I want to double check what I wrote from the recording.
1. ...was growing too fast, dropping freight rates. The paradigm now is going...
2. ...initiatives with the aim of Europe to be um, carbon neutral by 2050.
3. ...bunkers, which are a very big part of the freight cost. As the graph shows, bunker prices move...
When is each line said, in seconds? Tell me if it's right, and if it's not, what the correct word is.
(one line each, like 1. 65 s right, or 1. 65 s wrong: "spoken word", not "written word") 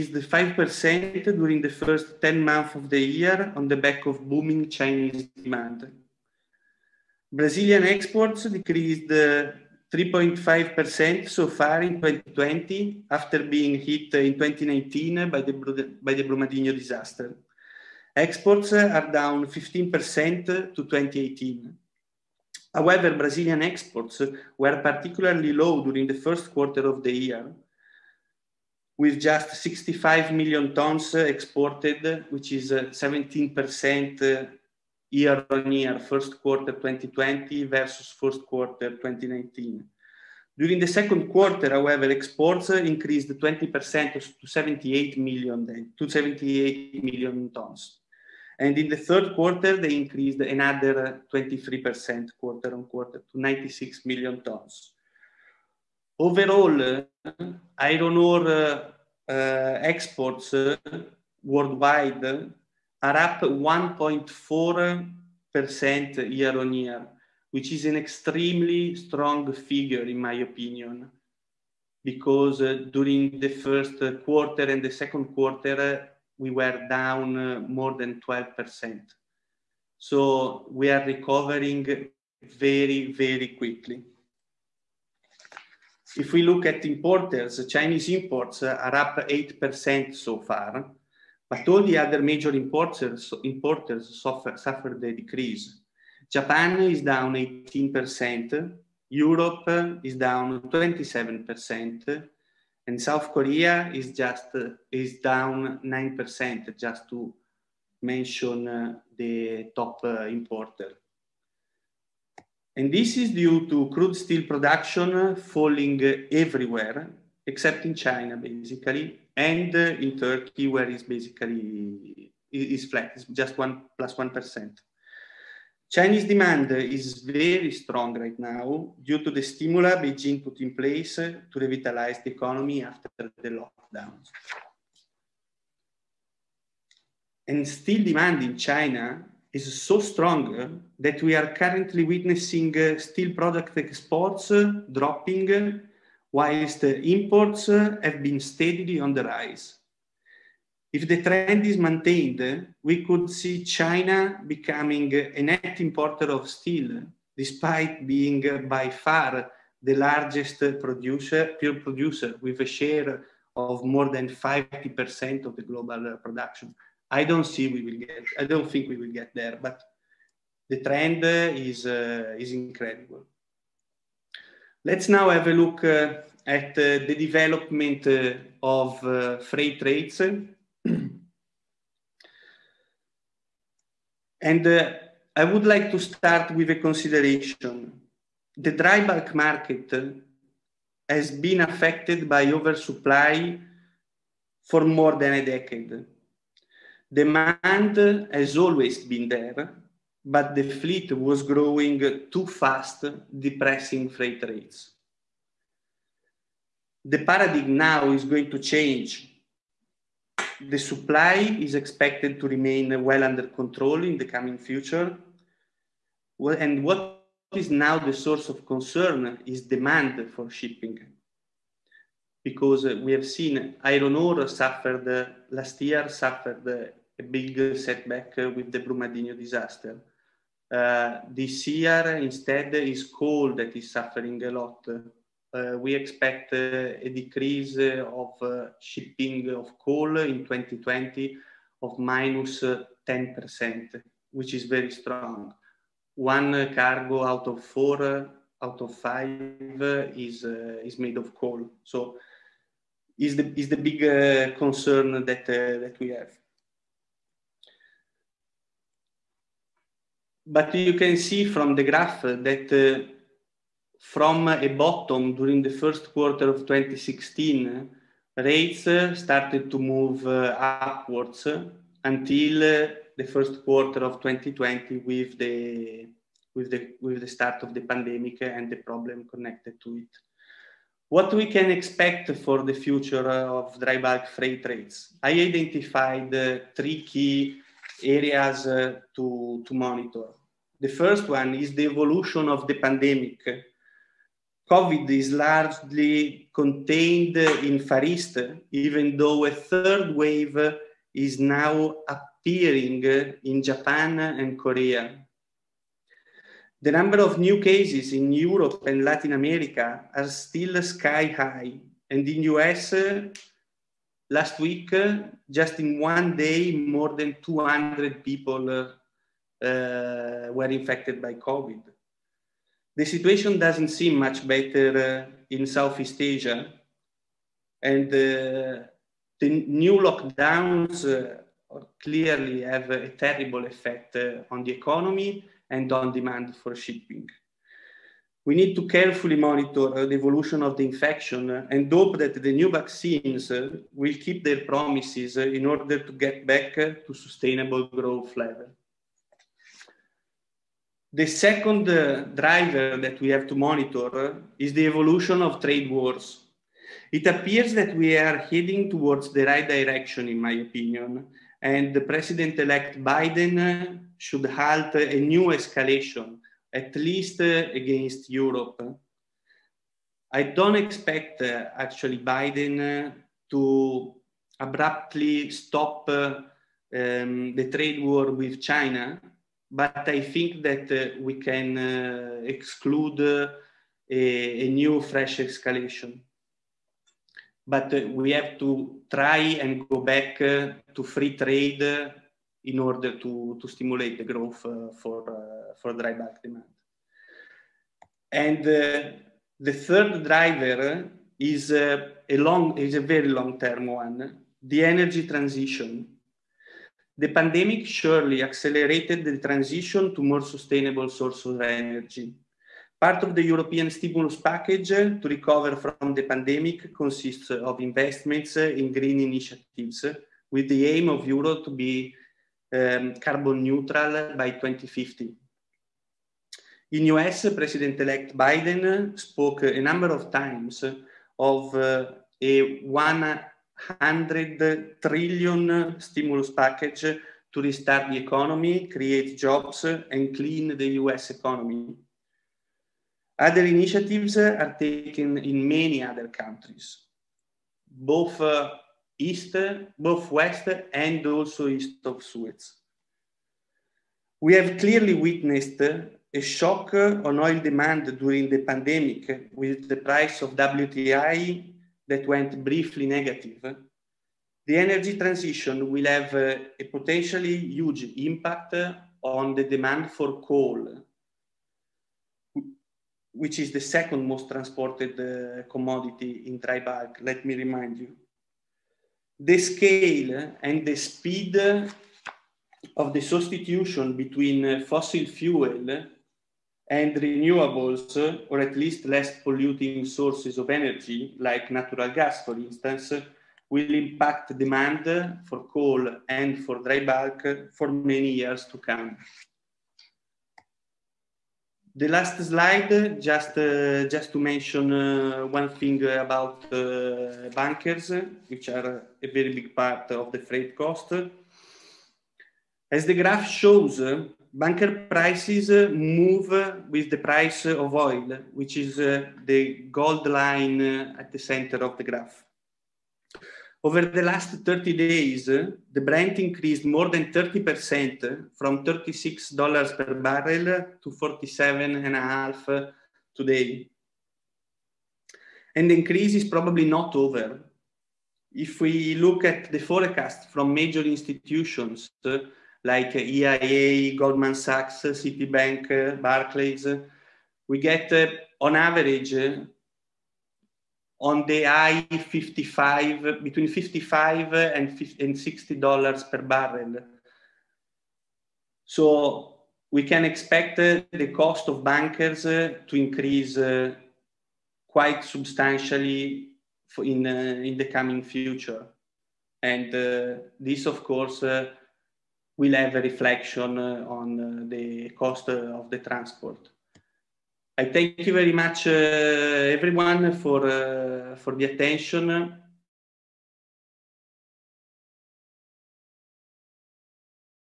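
1. 201 s wrong: "depressing", not "dropping"
2. 419 s right
3. 507 s right.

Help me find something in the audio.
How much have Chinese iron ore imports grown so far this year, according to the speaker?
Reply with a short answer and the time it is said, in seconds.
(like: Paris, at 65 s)
8%, at 89 s.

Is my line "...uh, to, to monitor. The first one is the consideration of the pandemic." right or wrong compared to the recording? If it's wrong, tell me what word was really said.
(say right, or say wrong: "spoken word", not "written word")
wrong: "evolution", not "consideration".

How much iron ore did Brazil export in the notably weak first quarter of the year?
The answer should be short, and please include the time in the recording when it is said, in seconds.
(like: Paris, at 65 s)
65 million tons, at 29 s.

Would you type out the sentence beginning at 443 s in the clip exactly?
Other initiatives are taken in many other countries, both uh, east, both west, and also east of Suez.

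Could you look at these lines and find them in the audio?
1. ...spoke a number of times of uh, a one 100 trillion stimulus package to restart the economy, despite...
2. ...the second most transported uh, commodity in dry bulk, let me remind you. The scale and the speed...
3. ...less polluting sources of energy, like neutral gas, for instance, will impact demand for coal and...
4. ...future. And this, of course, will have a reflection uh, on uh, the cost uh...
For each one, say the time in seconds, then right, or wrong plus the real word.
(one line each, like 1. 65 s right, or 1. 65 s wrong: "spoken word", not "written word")
1. 429 s wrong: "create", not "despite"
2. 473 s right
3. 489 s wrong: "natural", not "neutral"
4. 568 s right.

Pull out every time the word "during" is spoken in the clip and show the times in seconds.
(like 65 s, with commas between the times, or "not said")
1 s, 25 s, 40 s, 72 s, 265 s, 458 s.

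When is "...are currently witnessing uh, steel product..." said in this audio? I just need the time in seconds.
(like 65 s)
141 s.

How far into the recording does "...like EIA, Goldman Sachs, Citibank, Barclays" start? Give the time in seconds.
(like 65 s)
542 s.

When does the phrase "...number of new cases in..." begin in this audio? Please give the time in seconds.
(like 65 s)
306 s.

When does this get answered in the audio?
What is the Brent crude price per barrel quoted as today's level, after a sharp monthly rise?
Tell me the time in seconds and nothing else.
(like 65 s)
531 s.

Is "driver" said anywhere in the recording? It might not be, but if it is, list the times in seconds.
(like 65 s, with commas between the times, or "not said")
352 s, 400 s.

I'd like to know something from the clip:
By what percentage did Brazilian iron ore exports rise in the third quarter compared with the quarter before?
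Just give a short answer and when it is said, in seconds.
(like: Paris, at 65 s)
23%, at 51 s.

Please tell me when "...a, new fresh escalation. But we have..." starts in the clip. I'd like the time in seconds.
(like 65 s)
384 s.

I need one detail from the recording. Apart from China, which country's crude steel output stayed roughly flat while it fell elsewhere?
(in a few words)
Turkey.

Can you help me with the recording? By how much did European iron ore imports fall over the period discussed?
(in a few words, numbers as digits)
27%.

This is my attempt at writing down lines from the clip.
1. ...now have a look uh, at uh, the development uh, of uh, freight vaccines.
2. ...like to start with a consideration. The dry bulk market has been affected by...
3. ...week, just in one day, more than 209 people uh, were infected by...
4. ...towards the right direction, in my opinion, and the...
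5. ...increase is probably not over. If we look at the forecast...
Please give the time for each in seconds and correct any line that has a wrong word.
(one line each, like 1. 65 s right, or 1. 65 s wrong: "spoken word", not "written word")
1. 175 s wrong: "rates", not "vaccines"
2. 185 s right
3. 314 s wrong: "200", not "209"
4. 358 s right
5. 535 s right.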